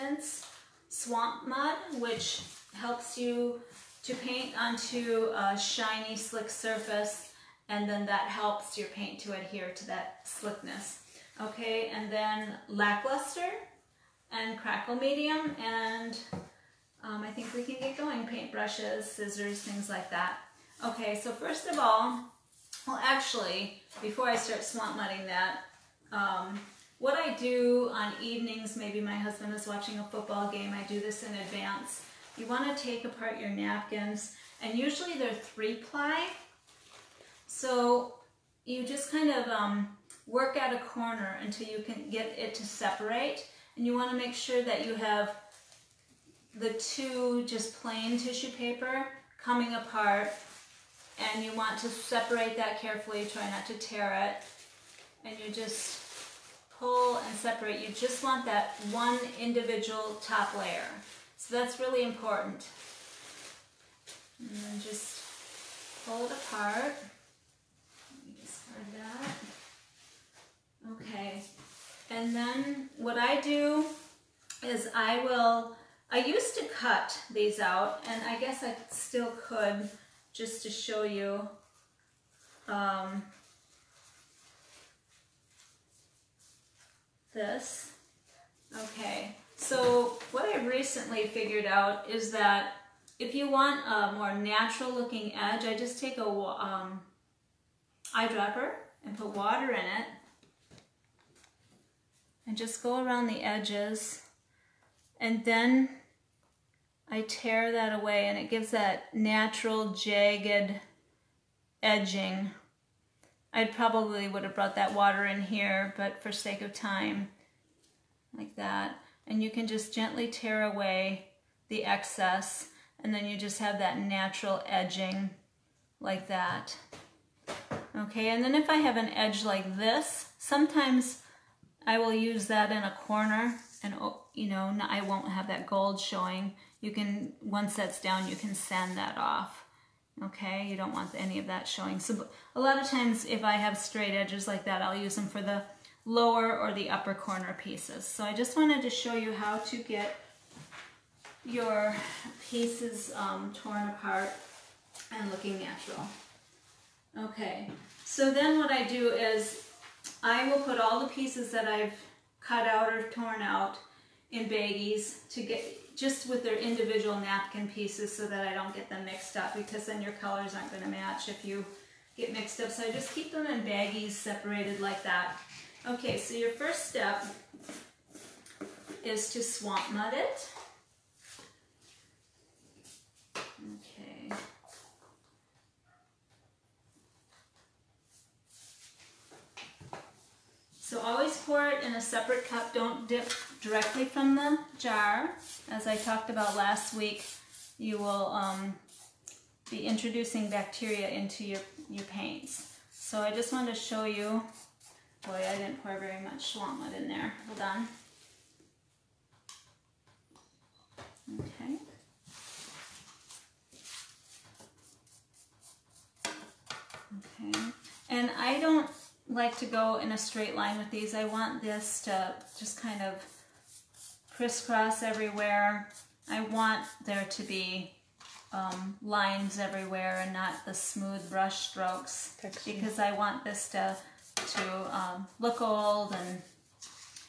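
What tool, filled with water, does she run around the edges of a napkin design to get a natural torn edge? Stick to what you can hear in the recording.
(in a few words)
Eyedropper.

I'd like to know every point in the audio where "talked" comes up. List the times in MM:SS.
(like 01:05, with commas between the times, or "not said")
03:15.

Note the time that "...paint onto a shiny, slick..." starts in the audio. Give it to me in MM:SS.
00:04.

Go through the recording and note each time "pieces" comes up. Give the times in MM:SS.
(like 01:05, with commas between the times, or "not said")
02:27, 02:32, 02:41, 02:47.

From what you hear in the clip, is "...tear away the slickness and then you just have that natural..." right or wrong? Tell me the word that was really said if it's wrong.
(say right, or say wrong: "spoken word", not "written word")
wrong: "excess", not "slickness".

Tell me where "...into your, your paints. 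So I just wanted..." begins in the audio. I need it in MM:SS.
03:21.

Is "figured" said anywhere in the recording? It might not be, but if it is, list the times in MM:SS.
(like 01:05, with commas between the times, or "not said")
01:31.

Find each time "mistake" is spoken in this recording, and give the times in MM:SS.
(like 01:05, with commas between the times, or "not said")
not said.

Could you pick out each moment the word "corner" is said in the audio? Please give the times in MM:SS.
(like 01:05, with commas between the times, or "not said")
00:40, 02:13, 02:27.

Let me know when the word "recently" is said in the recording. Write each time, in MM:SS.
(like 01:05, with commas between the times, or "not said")
01:30.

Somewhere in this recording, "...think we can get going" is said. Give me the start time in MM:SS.
00:17.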